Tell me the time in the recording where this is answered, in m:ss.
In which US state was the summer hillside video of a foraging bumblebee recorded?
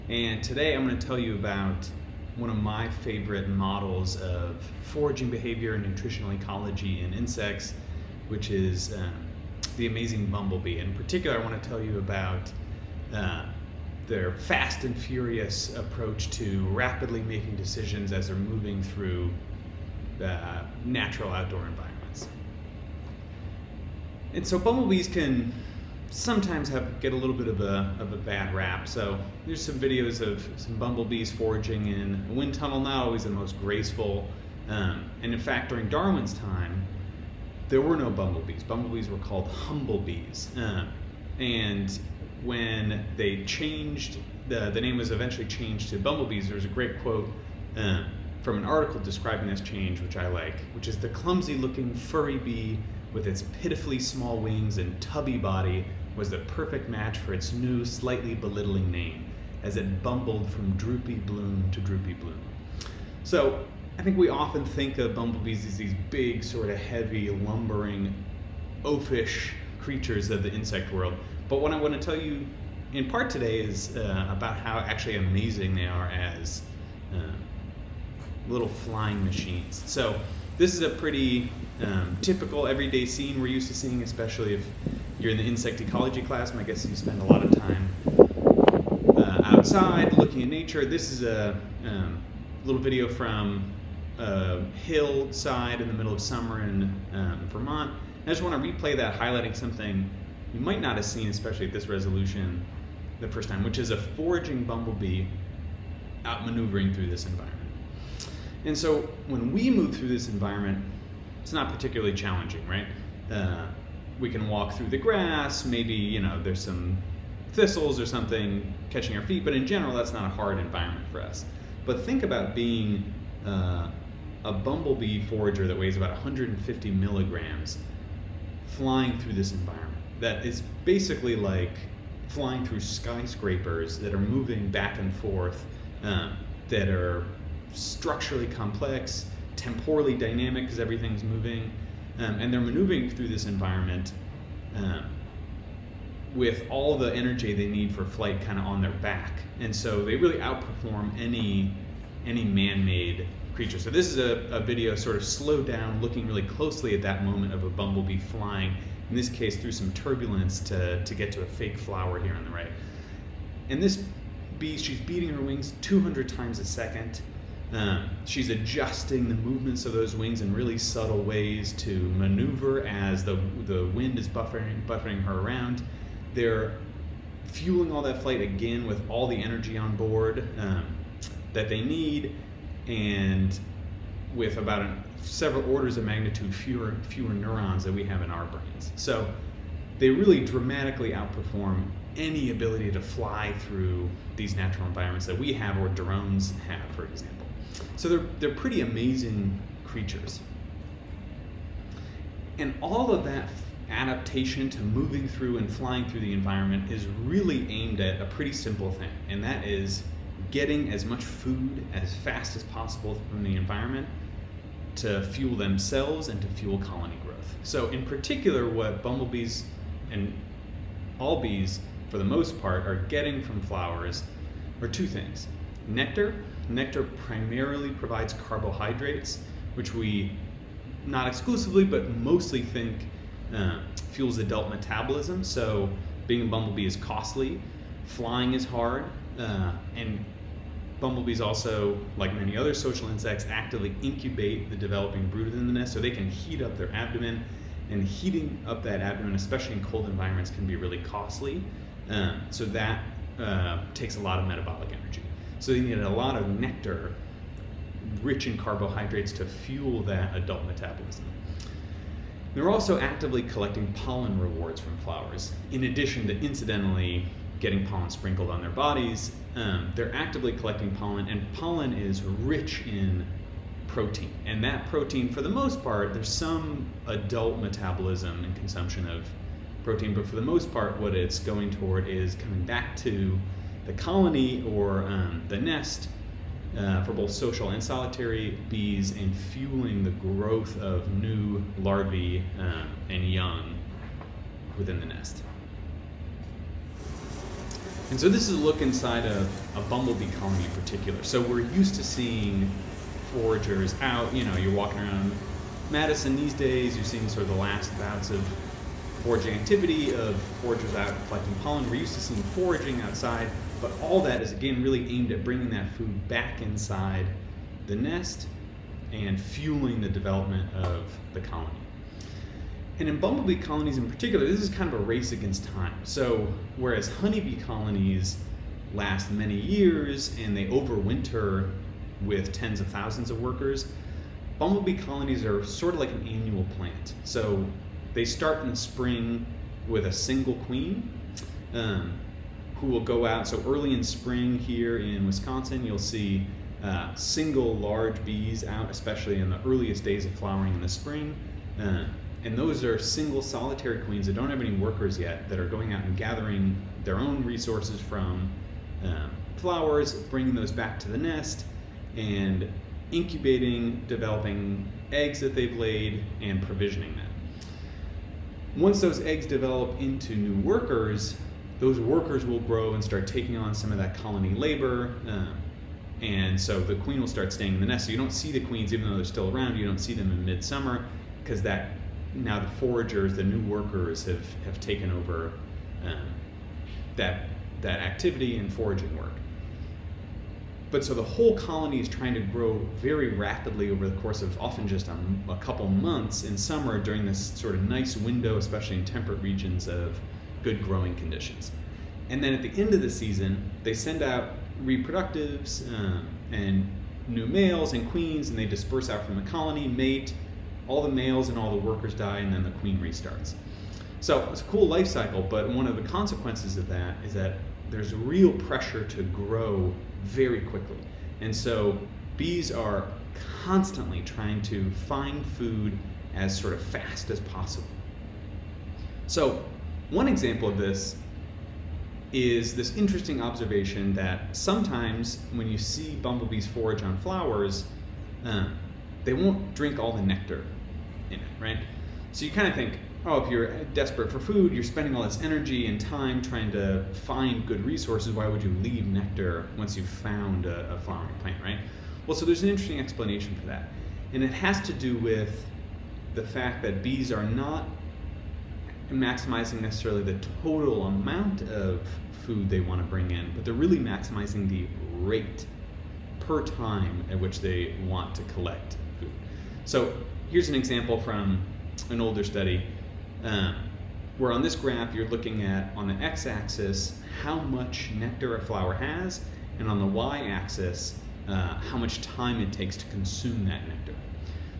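1:37.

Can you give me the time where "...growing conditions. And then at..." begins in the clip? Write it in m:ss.
6:40.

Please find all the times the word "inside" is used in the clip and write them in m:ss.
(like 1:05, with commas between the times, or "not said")
4:58, 5:16.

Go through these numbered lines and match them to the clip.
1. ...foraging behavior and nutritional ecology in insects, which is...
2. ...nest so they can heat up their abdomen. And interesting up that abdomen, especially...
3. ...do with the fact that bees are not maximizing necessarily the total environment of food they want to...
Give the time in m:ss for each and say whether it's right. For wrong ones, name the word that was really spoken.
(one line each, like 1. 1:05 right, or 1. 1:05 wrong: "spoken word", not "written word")
1. 0:04 right
2. 4:05 wrong: "heating", not "interesting"
3. 7:34 wrong: "amount", not "environment".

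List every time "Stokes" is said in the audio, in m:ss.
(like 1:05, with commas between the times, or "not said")
not said.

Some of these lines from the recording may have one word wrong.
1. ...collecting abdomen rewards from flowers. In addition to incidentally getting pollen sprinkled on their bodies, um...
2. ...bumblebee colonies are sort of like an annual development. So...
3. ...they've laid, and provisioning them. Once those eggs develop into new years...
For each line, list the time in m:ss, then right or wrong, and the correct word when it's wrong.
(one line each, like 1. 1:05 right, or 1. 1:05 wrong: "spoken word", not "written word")
1. 4:23 wrong: "pollen", not "abdomen"
2. 5:34 wrong: "plant", not "development"
3. 6:05 wrong: "workers", not "years".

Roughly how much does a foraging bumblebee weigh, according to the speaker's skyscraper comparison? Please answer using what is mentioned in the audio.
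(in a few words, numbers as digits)
150 milligrams.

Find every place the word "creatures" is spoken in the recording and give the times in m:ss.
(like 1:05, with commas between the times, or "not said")
1:09, 2:33, 3:19.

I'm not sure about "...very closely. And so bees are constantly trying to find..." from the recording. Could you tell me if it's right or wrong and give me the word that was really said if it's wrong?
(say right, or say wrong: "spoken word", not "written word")
wrong: "quickly", not "closely".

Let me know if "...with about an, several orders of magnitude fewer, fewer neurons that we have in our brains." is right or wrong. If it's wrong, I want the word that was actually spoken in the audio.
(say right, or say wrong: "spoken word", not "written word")
right.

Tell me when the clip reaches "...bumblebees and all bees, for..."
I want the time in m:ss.
3:39.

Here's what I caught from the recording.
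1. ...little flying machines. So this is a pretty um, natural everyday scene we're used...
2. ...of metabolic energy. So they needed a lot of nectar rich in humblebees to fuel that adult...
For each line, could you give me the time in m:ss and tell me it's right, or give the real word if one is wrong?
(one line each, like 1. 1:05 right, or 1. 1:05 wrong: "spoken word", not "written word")
1. 1:18 wrong: "typical", not "natural"
2. 4:14 wrong: "carbohydrates", not "humblebees".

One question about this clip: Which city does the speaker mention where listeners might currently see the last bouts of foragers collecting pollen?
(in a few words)
Madison.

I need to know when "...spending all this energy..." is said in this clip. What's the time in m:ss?
7:24.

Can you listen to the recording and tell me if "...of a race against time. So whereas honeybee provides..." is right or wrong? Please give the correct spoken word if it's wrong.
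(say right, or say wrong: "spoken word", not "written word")
wrong: "colonies", not "provides".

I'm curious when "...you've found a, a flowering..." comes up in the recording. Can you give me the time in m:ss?
7:29.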